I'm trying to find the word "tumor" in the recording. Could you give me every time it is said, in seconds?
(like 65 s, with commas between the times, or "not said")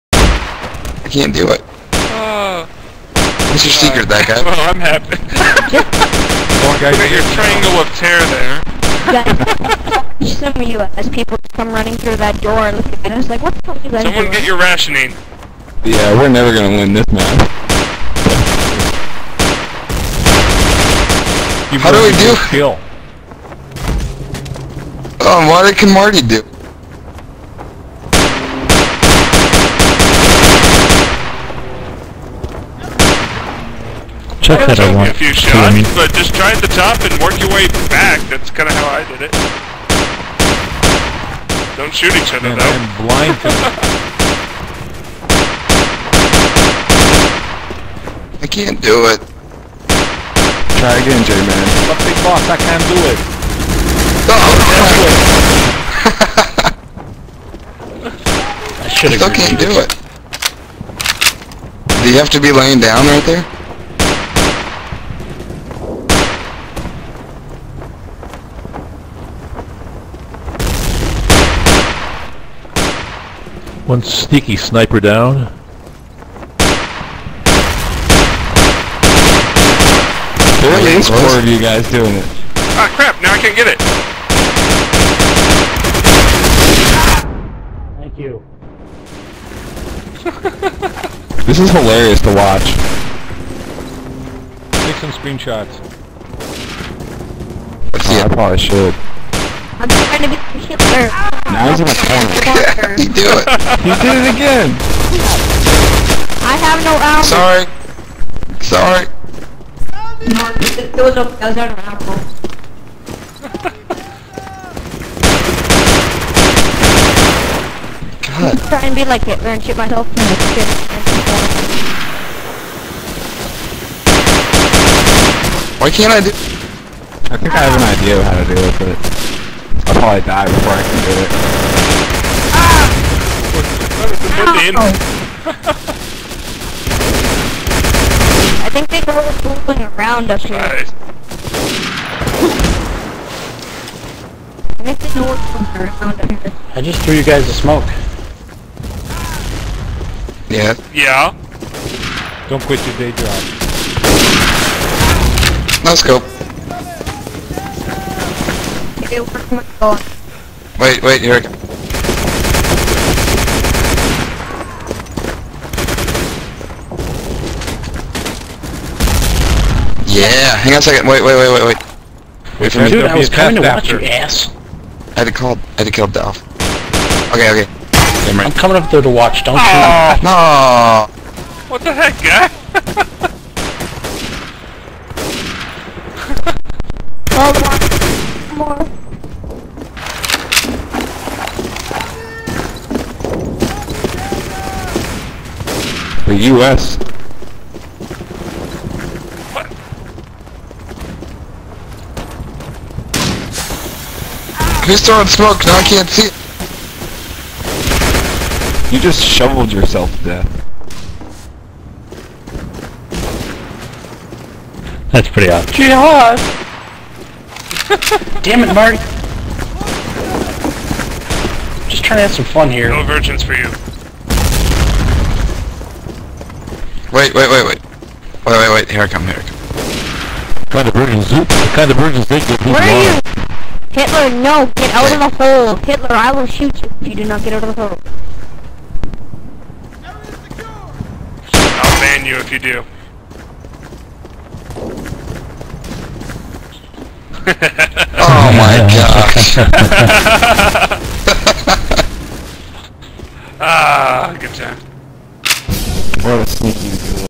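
not said.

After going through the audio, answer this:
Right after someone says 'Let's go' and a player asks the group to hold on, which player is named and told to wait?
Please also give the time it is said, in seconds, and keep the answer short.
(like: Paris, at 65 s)
Eric, at 161 s.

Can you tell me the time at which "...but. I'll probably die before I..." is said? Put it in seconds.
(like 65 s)
129 s.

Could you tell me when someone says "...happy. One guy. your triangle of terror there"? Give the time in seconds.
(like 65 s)
4 s.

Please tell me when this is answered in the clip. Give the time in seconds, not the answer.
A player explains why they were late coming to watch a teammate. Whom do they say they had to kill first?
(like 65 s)
176 s.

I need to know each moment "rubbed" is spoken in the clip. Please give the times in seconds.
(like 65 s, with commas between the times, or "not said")
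not said.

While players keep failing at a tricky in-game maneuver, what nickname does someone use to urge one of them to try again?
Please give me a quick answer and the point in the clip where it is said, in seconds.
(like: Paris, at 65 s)
J-Man, at 51 s.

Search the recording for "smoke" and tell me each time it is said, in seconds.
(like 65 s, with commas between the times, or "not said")
147 s, 205 s.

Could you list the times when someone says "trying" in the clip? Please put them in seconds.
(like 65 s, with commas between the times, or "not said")
99 s, 118 s, 222 s.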